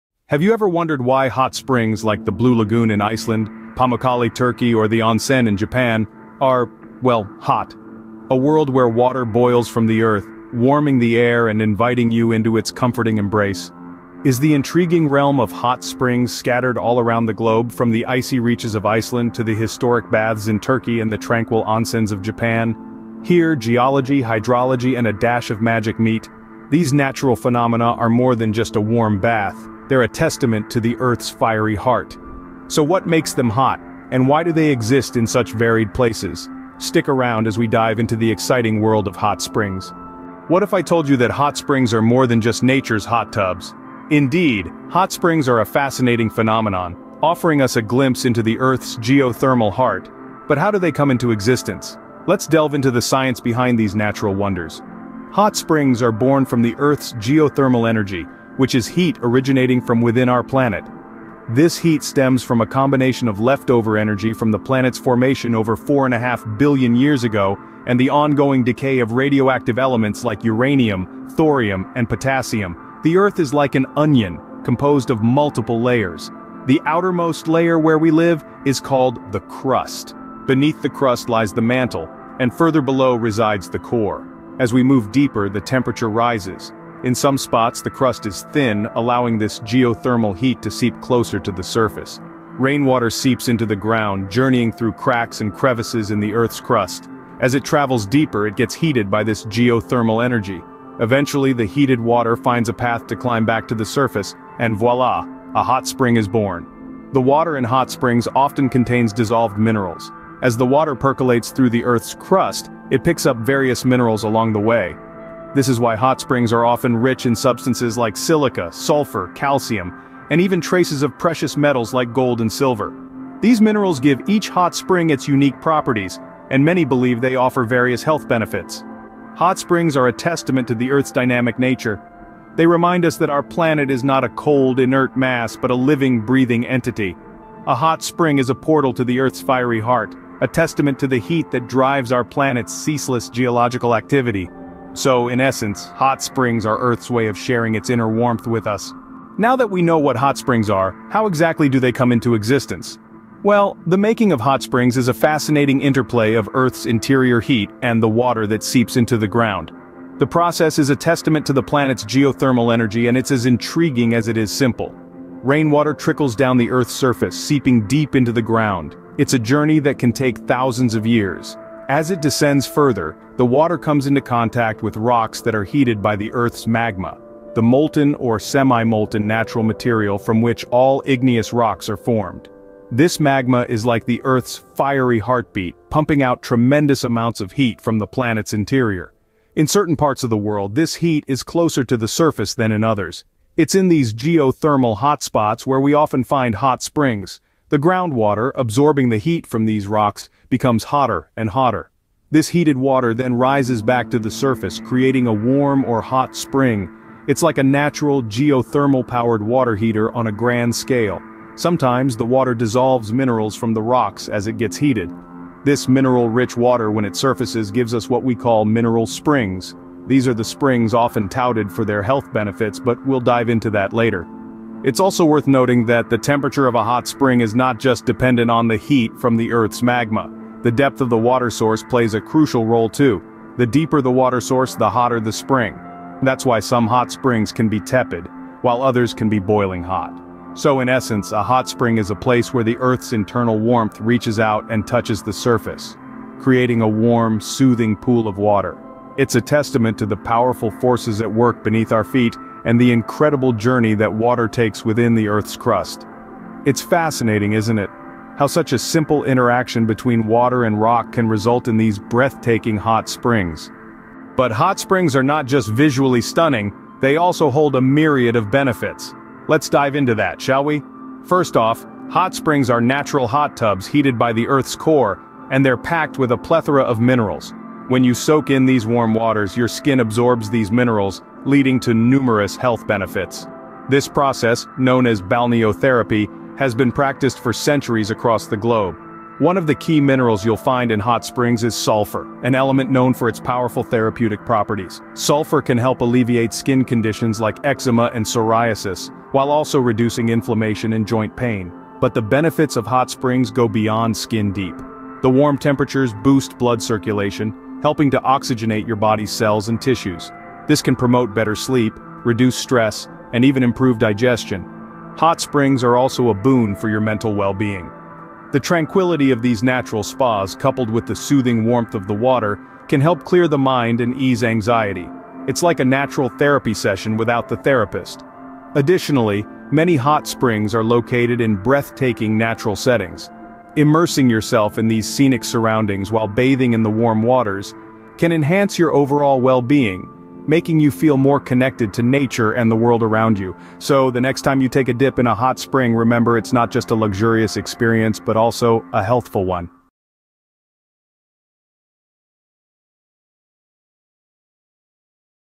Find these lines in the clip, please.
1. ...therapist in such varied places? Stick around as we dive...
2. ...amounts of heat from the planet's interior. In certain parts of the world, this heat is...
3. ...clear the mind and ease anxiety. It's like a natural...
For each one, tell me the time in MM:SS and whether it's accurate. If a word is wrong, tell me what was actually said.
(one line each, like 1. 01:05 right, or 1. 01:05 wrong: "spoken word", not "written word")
1. 00:34 wrong: "exist", not "therapist"
2. 03:07 right
3. 05:23 right.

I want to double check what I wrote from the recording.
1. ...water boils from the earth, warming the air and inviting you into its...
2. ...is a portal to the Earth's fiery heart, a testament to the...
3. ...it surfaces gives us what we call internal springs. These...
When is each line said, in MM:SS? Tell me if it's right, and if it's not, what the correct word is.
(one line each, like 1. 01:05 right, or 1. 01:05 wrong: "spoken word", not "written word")
1. 00:08 right
2. 02:18 right
3. 03:37 wrong: "mineral", not "internal".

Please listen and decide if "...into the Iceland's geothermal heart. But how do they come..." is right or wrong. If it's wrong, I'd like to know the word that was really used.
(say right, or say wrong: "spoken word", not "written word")
wrong: "Earth", not "Iceland".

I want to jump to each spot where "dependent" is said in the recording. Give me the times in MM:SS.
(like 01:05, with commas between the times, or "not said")
03:48.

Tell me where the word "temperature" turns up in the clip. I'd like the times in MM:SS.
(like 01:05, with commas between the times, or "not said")
01:25, 03:46, 05:05.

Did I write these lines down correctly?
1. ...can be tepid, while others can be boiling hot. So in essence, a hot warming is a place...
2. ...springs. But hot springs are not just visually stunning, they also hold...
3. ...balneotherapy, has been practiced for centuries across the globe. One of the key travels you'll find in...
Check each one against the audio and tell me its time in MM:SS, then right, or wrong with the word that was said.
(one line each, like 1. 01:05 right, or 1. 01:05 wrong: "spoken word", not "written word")
1. 03:57 wrong: "spring", not "warming"
2. 04:23 right
3. 04:45 wrong: "minerals", not "travels".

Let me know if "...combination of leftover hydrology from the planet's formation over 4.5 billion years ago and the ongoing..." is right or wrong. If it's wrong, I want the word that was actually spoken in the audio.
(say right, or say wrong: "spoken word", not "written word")
wrong: "energy", not "hydrology".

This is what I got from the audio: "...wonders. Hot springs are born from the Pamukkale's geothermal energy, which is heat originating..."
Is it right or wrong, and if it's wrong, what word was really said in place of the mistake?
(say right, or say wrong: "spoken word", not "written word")
wrong: "Earth", not "Pamukkale".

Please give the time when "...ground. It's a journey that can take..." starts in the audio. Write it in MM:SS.
02:48.